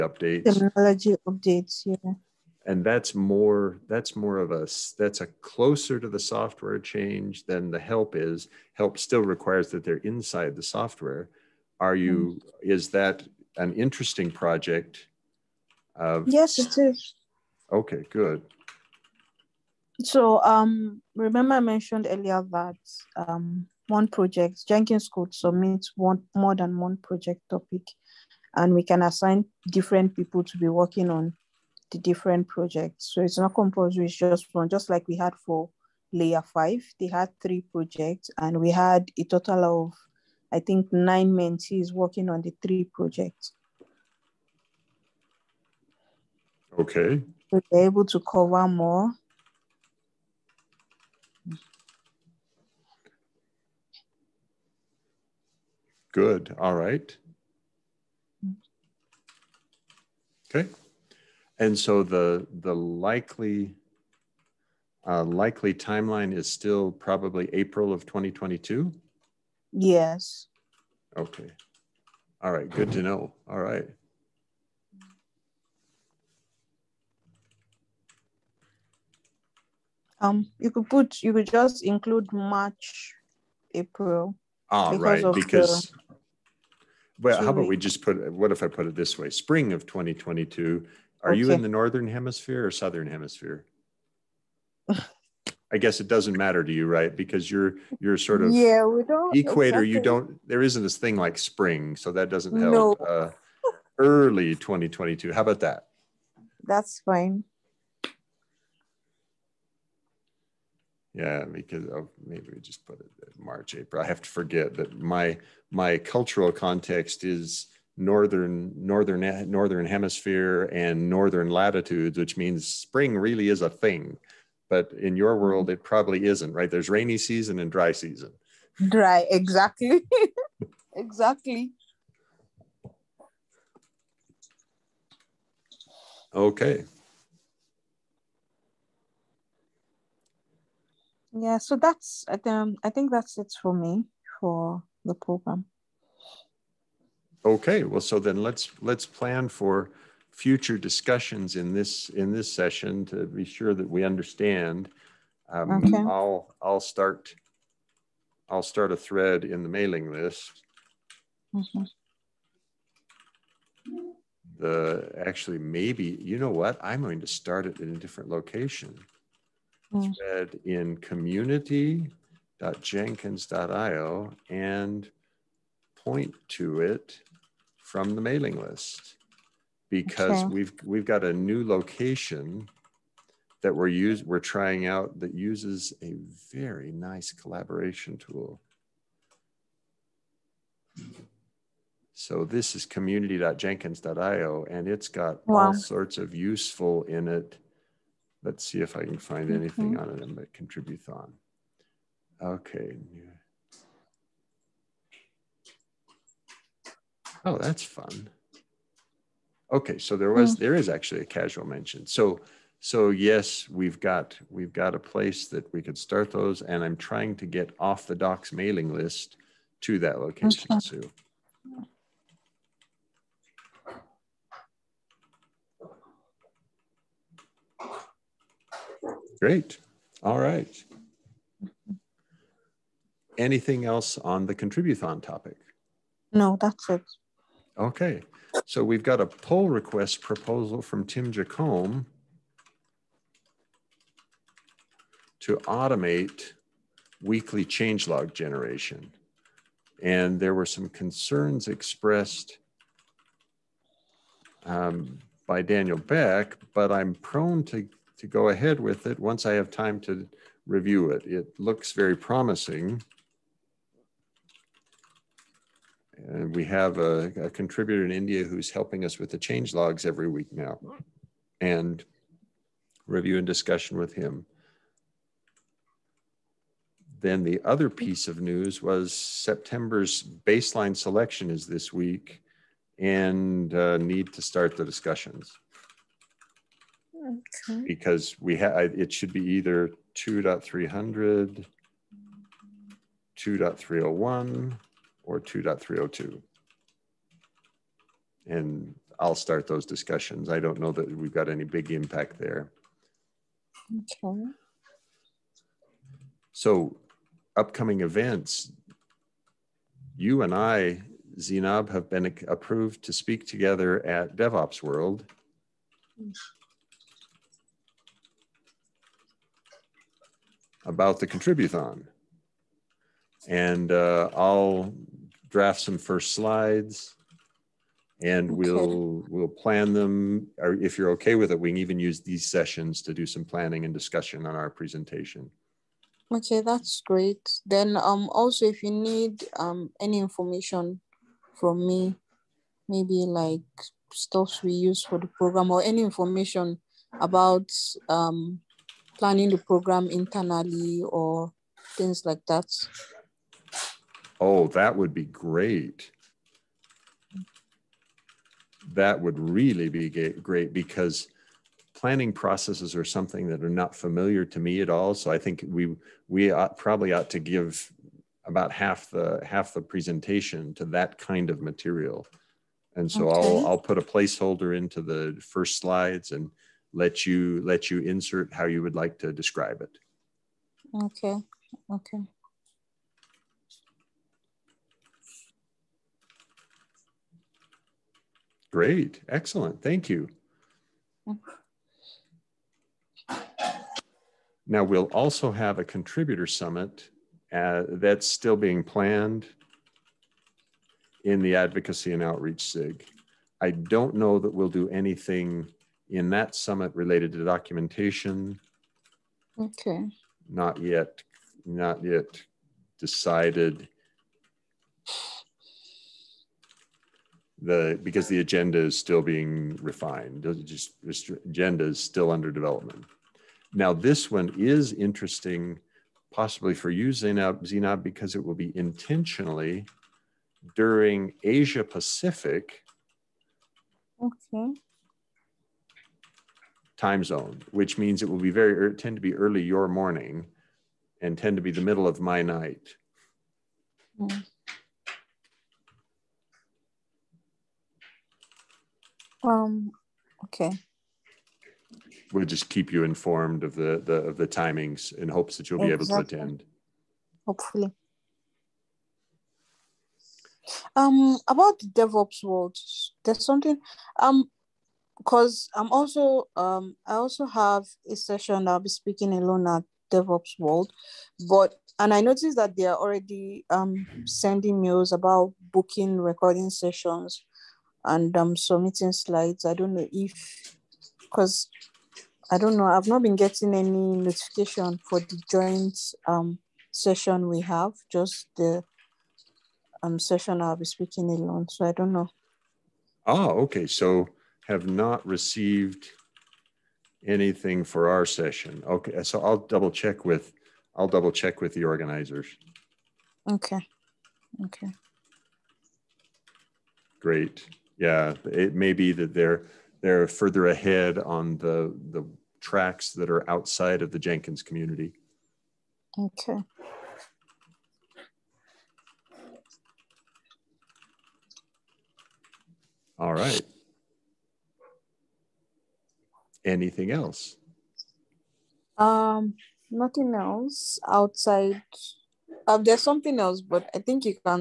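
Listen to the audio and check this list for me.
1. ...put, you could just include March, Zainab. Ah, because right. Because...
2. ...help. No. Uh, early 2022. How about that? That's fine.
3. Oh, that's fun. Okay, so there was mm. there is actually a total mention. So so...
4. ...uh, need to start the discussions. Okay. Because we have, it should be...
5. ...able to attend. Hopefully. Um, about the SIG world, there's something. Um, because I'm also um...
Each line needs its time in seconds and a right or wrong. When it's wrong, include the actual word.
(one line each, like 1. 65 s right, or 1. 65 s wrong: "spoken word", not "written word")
1. 80 s wrong: "April", not "Zainab"
2. 102 s right
3. 207 s wrong: "casual", not "total"
4. 283 s right
5. 455 s wrong: "DevOps", not "SIG".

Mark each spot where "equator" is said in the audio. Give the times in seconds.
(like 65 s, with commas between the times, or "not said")
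99 s.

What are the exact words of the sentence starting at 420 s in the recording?
just agenda is still under development.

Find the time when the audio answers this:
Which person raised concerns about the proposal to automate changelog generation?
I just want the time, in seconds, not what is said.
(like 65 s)
255 s.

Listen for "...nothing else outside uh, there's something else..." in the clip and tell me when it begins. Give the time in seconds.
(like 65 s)
529 s.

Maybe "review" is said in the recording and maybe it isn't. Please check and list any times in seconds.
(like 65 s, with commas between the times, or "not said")
260 s, 273 s.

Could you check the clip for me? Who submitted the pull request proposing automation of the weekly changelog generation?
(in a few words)
Tim Jacomb.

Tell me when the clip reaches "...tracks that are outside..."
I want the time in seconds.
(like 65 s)
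512 s.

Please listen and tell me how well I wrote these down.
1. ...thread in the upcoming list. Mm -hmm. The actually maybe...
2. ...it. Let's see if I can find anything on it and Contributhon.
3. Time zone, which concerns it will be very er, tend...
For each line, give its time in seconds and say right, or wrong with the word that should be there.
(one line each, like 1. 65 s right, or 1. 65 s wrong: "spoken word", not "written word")
1. 158 s wrong: "mailing", not "upcoming"
2. 197 s right
3. 436 s wrong: "means", not "concerns".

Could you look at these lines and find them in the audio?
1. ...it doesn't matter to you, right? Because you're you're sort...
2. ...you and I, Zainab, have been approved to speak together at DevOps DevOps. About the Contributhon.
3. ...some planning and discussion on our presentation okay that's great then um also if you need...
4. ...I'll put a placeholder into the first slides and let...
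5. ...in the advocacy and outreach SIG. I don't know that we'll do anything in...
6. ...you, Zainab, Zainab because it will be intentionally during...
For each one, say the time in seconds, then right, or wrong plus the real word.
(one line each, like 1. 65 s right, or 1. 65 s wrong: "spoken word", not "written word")
1. 95 s right
2. 310 s wrong: "World", not "DevOps"
3. 333 s right
4. 373 s right
5. 401 s right
6. 426 s right.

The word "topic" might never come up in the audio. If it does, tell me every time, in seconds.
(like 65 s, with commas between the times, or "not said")
27 s, 235 s.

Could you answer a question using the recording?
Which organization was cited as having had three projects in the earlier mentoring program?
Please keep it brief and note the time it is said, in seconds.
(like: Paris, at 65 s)
Layer5, at 36 s.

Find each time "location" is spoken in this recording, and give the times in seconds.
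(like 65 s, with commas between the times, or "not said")
168 s, 181 s, 220 s.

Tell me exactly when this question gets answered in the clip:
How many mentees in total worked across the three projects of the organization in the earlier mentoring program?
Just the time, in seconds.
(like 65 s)
40 s.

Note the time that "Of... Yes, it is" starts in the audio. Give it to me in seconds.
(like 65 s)
15 s.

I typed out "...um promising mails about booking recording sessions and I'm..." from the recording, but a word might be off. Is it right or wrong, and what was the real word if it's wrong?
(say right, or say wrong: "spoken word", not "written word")
wrong: "sending", not "promising".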